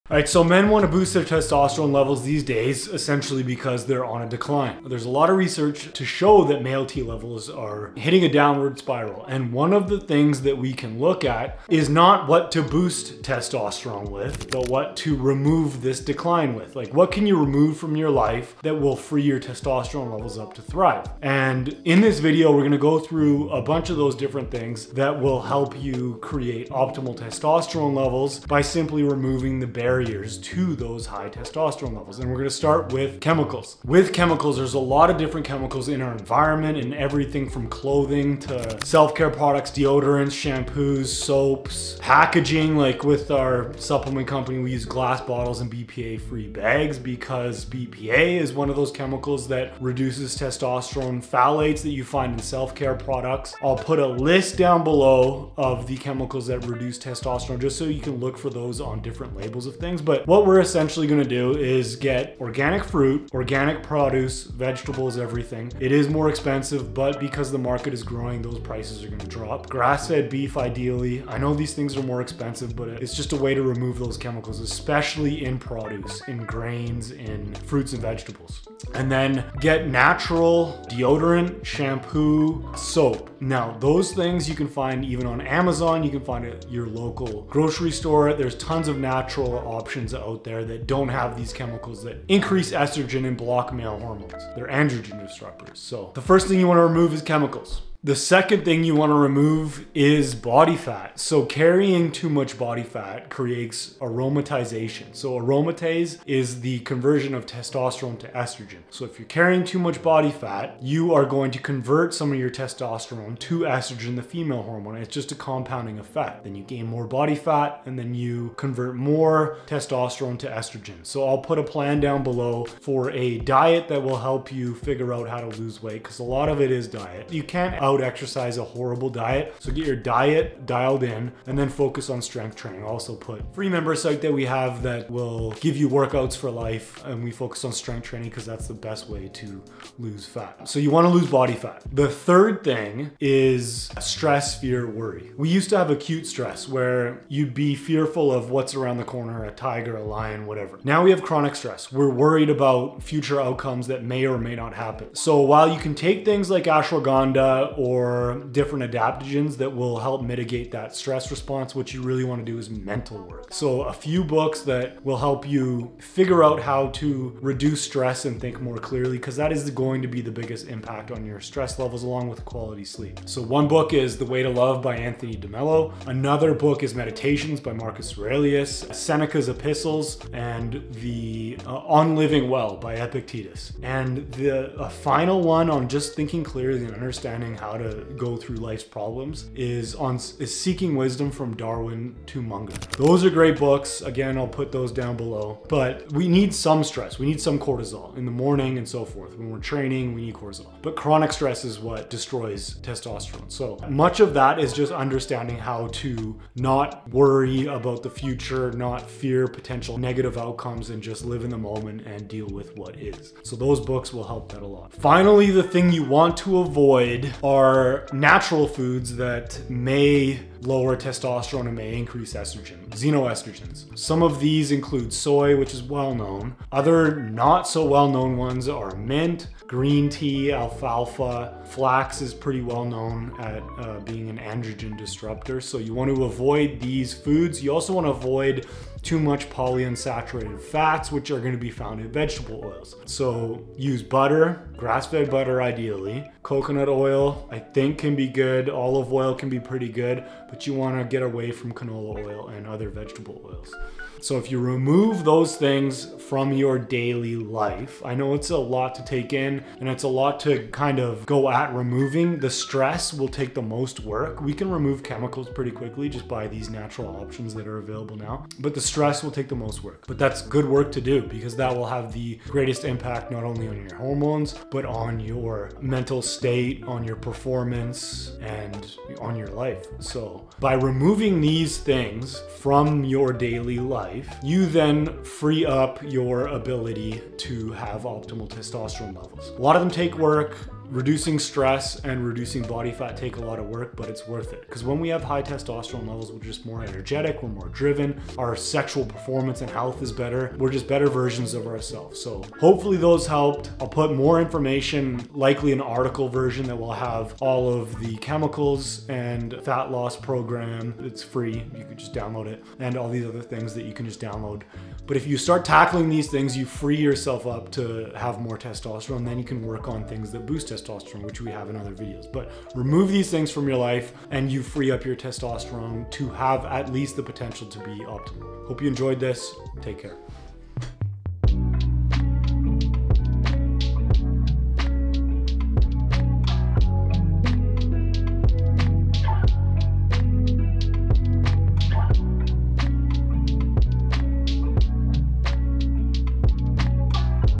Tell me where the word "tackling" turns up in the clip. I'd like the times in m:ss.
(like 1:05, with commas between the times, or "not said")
5:15.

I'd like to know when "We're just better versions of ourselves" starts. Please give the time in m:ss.
5:00.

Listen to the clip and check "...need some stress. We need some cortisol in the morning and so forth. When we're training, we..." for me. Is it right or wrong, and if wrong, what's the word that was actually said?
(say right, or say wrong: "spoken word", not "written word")
right.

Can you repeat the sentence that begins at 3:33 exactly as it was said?
So those books will help that a lot.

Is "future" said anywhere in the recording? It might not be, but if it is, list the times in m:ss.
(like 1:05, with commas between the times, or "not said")
2:33, 3:28.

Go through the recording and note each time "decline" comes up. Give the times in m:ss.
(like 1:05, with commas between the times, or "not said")
0:04, 0:16.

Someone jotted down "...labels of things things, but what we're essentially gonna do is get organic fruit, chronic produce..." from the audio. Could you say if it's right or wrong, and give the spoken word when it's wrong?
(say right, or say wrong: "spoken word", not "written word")
wrong: "organic", not "chronic".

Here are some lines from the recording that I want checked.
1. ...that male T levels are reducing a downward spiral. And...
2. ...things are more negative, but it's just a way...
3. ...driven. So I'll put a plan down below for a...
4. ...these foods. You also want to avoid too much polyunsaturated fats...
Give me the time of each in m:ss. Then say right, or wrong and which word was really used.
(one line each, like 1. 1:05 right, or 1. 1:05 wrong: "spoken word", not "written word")
1. 0:06 wrong: "hitting", not "reducing"
2. 1:11 wrong: "expensive", not "negative"
3. 2:00 wrong: "estrogen", not "driven"
4. 3:56 right.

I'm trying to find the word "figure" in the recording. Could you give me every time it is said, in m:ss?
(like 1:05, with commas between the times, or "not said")
2:04, 2:45.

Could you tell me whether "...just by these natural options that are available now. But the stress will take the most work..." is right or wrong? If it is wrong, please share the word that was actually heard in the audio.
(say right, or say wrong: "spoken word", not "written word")
right.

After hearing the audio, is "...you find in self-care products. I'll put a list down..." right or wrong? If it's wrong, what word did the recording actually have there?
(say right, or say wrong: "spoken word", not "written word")
right.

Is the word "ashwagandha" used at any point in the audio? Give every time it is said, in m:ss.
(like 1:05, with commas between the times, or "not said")
2:36.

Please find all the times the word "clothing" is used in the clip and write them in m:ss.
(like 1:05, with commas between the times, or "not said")
0:37.